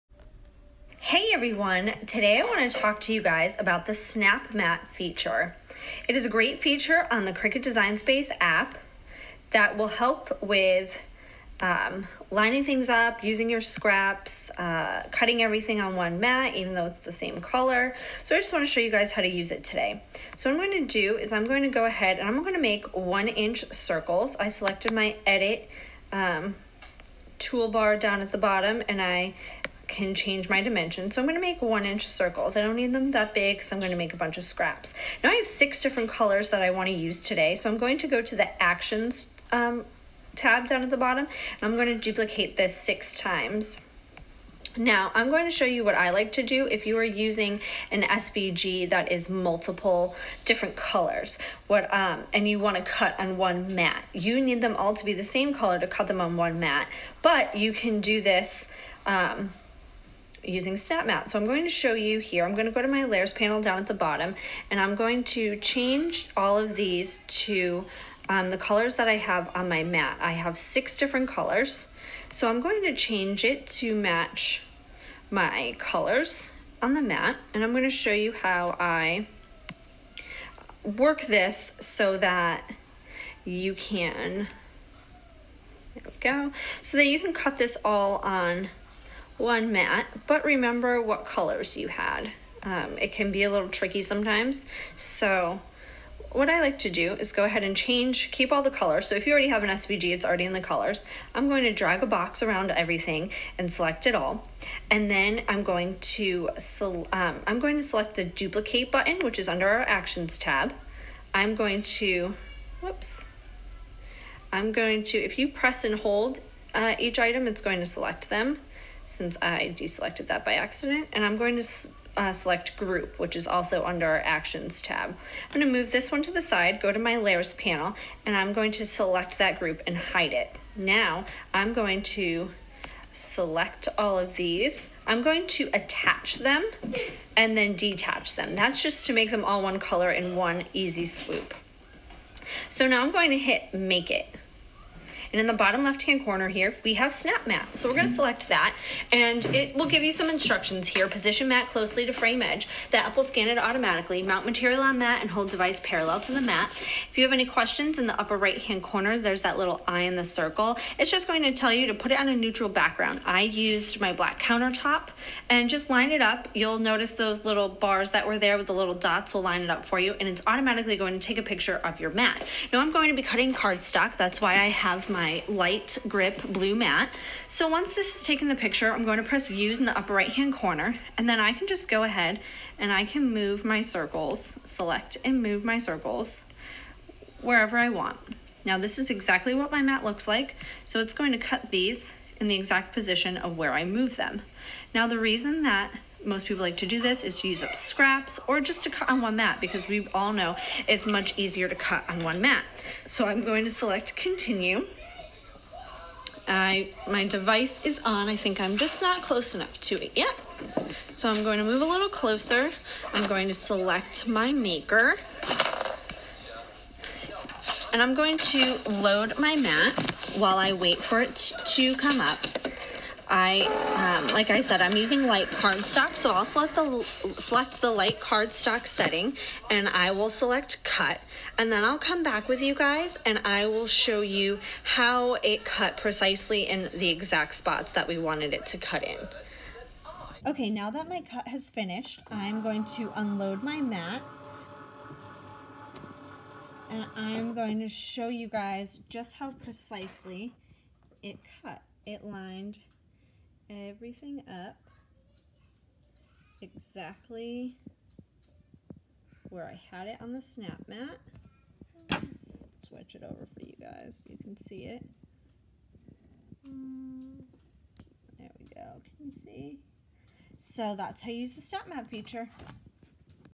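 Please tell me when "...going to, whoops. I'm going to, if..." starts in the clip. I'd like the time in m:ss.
1:51.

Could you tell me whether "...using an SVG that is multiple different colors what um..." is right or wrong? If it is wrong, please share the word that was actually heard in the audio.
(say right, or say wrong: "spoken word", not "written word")
right.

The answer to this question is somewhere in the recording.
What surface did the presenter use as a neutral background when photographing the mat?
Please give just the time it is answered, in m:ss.
2:44.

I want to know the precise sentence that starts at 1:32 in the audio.
Um, it can be a little tricky sometimes.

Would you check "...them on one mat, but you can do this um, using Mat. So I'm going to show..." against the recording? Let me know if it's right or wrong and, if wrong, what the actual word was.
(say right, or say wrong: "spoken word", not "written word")
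wrong: "SnapMat", not "Mat".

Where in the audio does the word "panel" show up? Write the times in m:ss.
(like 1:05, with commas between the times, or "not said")
1:03, 2:07.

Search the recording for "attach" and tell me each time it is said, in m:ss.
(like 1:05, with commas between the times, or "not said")
2:15.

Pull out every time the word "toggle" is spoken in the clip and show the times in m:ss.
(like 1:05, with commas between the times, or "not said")
not said.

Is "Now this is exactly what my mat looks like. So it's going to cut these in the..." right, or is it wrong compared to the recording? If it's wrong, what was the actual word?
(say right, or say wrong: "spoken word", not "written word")
right.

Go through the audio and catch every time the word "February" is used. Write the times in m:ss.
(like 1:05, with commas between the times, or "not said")
not said.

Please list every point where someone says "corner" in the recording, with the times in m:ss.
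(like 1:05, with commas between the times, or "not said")
2:26, 2:38, 3:00.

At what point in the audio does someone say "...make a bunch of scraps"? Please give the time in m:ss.
0:33.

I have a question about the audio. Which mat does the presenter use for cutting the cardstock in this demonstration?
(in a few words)
light grip blue mat.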